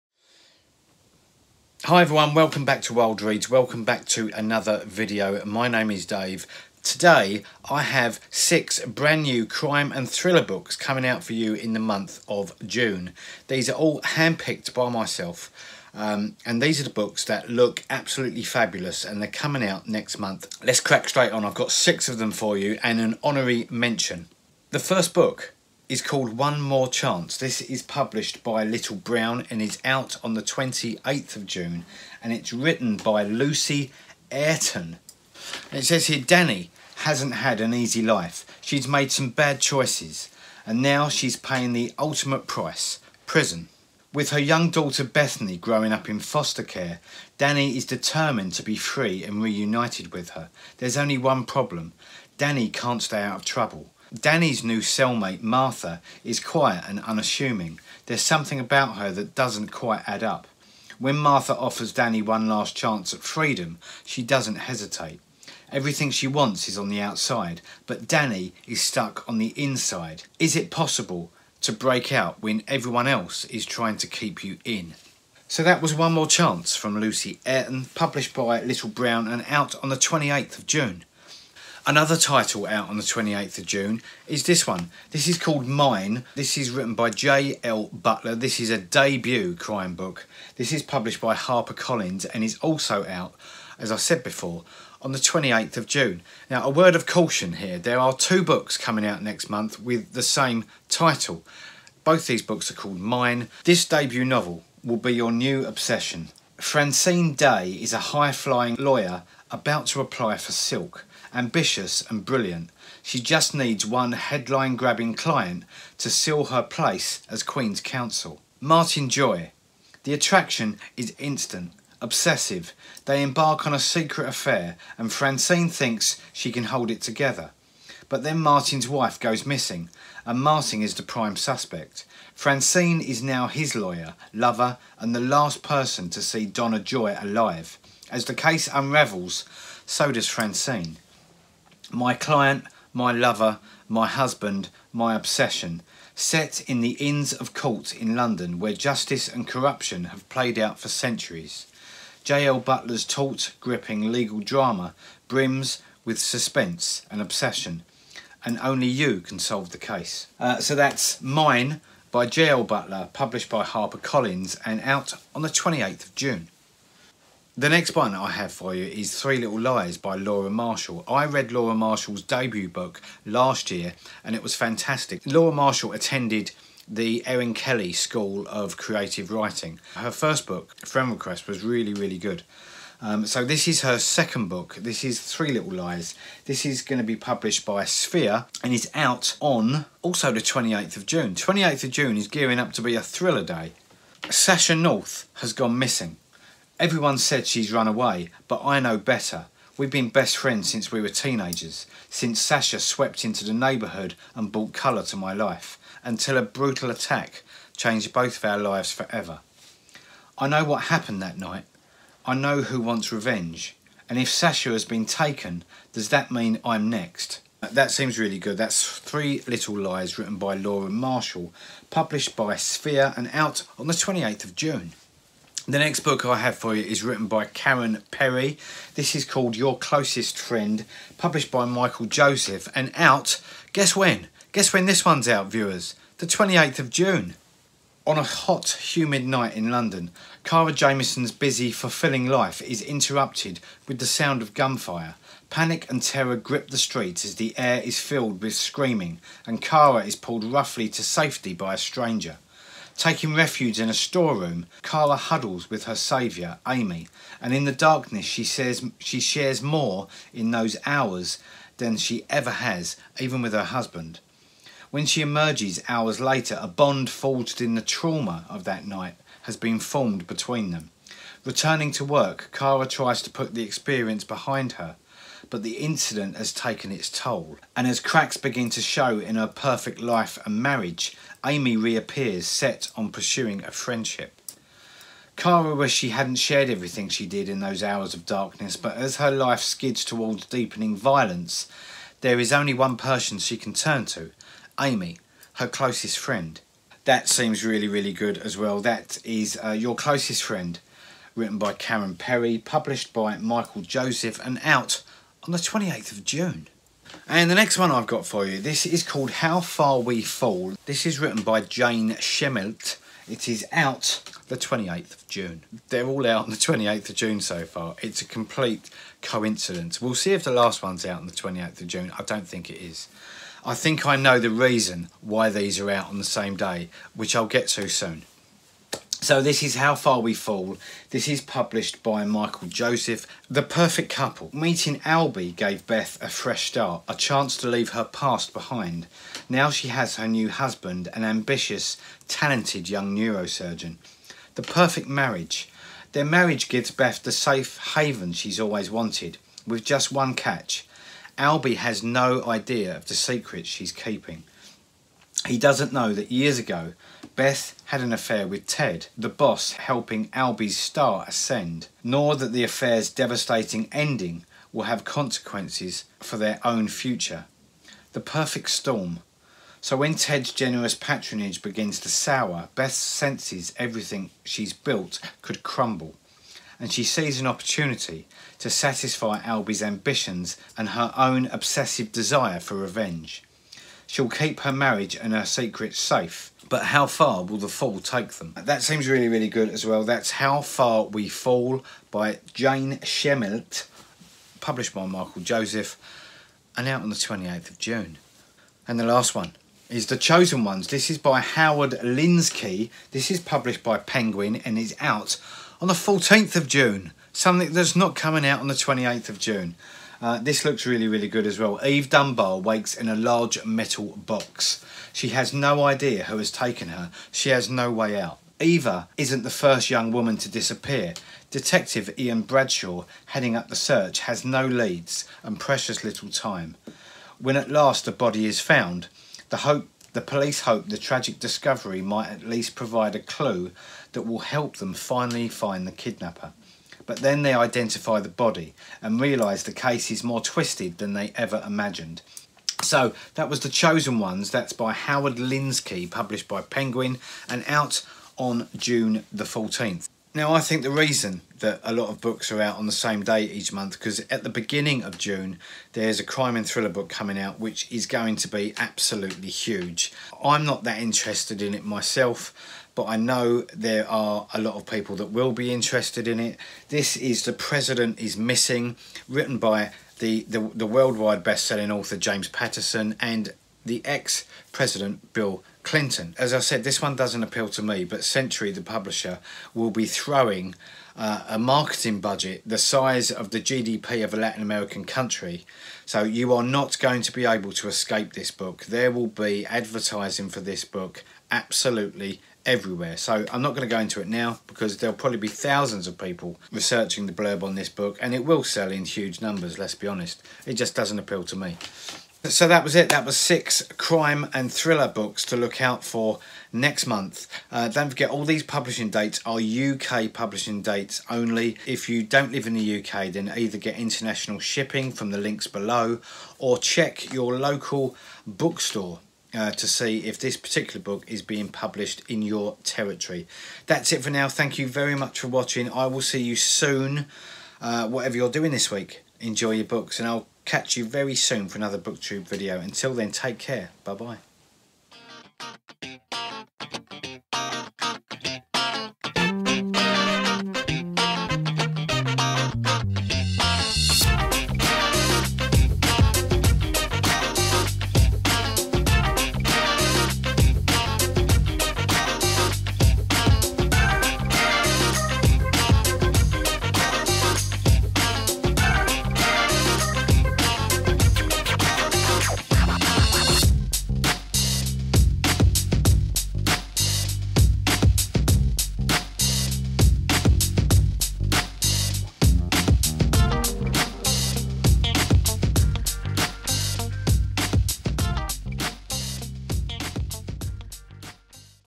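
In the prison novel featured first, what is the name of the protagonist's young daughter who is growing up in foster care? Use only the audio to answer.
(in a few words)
Bethany.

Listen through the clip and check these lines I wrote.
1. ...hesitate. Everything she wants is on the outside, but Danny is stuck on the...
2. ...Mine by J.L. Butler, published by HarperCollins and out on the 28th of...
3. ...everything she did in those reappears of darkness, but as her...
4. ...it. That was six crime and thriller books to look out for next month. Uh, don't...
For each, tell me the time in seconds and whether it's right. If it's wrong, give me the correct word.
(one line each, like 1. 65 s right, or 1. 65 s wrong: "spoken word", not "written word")
1. 64 s right
2. 161 s right
3. 286 s wrong: "hours", not "reappears"
4. 502 s right.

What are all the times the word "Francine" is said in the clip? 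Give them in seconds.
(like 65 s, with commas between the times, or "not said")
106 s, 125 s, 132 s, 140 s.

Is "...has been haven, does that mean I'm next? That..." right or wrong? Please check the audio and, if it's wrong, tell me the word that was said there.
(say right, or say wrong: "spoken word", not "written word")
wrong: "taken", not "haven".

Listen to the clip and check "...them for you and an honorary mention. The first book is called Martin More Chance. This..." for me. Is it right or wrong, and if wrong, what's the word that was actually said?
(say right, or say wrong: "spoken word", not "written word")
wrong: "One", not "Martin".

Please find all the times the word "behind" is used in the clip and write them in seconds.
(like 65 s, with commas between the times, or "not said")
274 s, 338 s.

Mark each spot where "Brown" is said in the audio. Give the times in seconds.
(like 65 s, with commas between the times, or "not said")
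28 s, 78 s.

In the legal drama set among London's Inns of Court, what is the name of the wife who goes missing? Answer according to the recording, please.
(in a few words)
Donna Joy.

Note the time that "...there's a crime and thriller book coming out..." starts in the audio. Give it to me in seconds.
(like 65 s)
455 s.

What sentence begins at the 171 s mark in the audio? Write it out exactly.
I read Laura Marshall's debut book last year and it was fantastic.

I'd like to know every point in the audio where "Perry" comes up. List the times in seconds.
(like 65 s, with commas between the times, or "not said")
228 s, 302 s.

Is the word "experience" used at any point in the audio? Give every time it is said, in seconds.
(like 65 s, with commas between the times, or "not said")
273 s.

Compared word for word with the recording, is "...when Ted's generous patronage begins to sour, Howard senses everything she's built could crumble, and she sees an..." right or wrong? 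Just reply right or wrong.
wrong.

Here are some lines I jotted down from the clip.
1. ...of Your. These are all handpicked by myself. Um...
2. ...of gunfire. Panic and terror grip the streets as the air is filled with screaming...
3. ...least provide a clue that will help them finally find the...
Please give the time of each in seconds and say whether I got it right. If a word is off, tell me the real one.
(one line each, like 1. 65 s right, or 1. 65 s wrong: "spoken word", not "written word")
1. 12 s wrong: "June", not "Your"
2. 244 s right
3. 432 s right.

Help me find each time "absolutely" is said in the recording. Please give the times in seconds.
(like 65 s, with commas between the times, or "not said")
17 s, 458 s, 491 s.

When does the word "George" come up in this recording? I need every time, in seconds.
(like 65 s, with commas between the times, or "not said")
not said.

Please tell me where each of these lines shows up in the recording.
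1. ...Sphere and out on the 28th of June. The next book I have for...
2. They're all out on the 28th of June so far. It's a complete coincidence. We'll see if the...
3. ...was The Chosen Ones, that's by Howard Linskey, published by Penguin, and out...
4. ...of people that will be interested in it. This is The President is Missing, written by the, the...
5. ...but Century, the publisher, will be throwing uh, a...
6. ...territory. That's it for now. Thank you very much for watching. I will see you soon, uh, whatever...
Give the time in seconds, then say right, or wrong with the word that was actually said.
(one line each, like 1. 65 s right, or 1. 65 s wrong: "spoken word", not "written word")
1. 222 s right
2. 315 s right
3. 443 s right
4. 464 s right
5. 478 s right
6. 522 s right.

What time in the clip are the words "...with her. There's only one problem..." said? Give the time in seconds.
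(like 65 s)
50 s.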